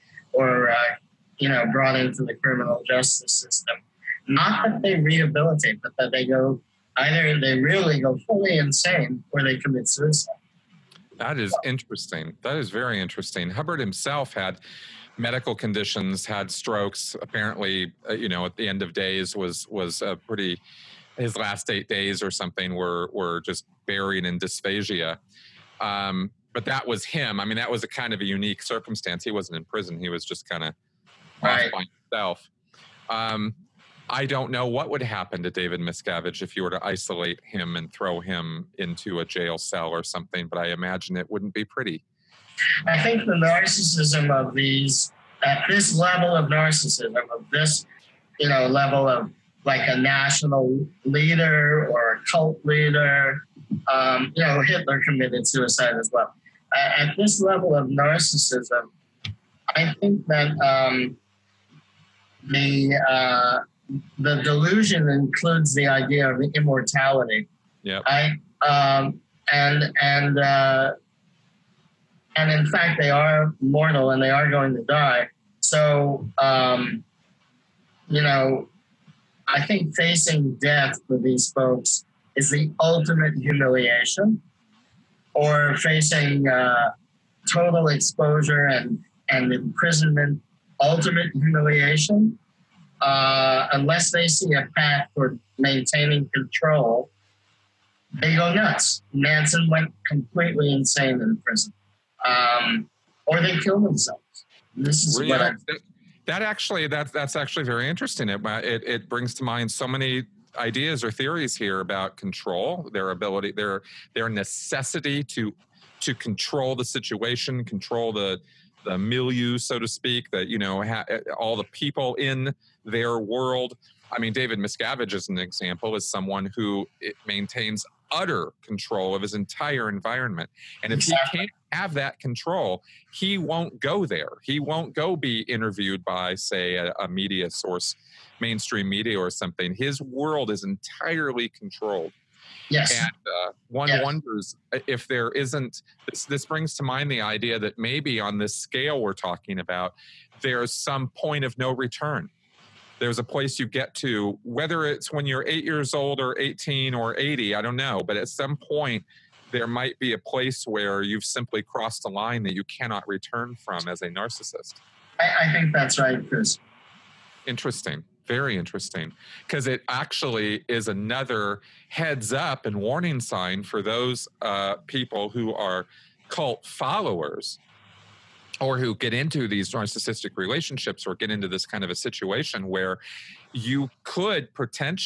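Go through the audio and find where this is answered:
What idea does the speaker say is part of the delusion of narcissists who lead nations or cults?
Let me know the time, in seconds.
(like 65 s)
66 s.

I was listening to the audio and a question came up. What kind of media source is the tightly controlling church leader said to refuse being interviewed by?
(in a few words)
mainstream media.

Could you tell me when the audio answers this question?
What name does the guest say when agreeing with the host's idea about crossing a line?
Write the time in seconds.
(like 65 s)
166 s.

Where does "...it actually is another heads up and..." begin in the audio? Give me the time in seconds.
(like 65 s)
169 s.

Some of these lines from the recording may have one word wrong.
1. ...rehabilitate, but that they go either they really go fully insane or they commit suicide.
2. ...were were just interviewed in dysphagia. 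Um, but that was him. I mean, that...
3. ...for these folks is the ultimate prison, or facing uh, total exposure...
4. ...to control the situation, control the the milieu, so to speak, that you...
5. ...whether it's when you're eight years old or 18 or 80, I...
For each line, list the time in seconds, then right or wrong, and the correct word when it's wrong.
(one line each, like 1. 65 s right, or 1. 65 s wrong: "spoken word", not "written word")
1. 4 s right
2. 22 s wrong: "buried", not "interviewed"
3. 81 s wrong: "humiliation", not "prison"
4. 115 s right
5. 154 s right.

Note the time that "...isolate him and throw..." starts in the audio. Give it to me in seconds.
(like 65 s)
36 s.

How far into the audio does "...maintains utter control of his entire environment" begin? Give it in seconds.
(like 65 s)
127 s.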